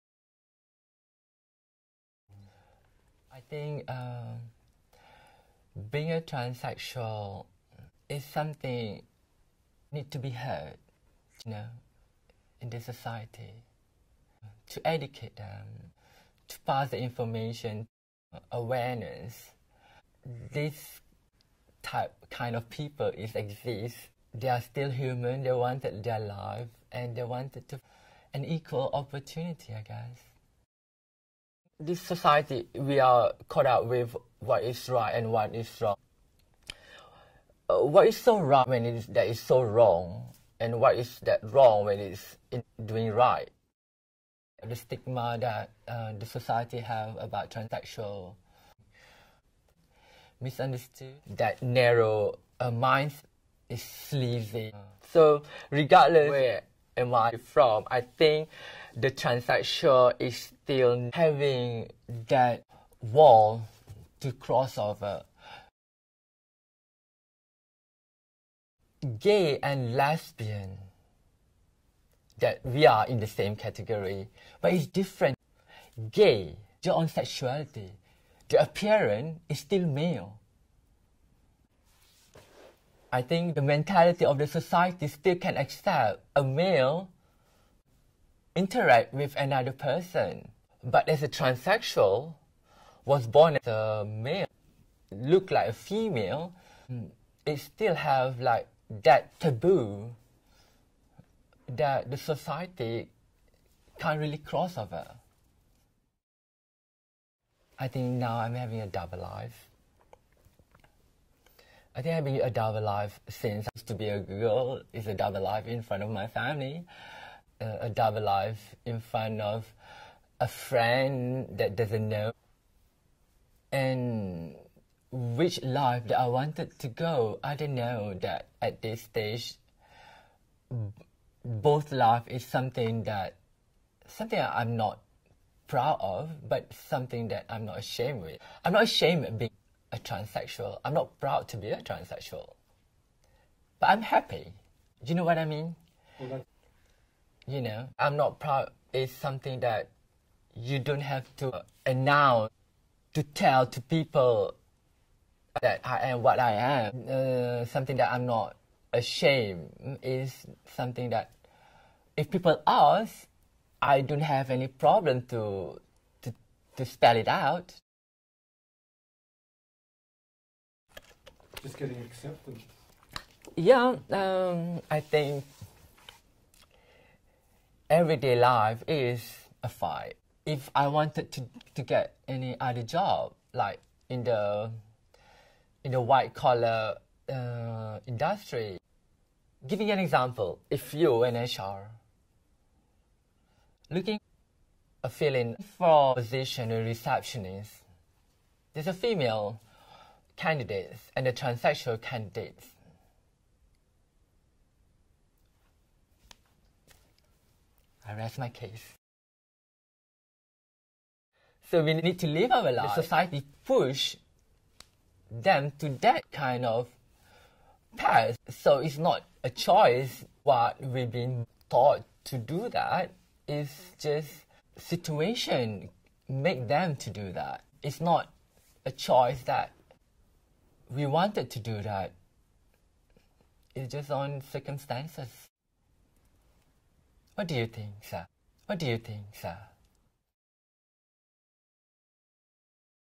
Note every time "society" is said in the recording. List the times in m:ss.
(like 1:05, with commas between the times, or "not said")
0:12, 0:31, 0:46, 1:24, 1:42, 3:32.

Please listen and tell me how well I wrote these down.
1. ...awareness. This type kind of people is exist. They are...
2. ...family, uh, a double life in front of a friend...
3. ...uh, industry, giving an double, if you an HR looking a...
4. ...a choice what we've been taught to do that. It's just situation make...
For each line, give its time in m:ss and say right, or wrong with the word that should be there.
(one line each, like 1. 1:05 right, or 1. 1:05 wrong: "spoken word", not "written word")
1. 0:18 right
2. 1:56 right
3. 3:07 wrong: "example", not "double"
4. 3:39 right.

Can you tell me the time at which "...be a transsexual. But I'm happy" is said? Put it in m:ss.
2:21.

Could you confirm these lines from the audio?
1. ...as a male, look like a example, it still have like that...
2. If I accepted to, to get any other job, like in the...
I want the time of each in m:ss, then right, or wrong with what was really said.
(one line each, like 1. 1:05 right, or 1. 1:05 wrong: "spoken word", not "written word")
1. 1:33 wrong: "female", not "example"
2. 3:00 wrong: "wanted", not "accepted".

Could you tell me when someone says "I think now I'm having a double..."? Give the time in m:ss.
1:47.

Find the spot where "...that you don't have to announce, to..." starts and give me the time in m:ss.
2:29.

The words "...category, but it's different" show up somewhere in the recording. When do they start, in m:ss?
1:13.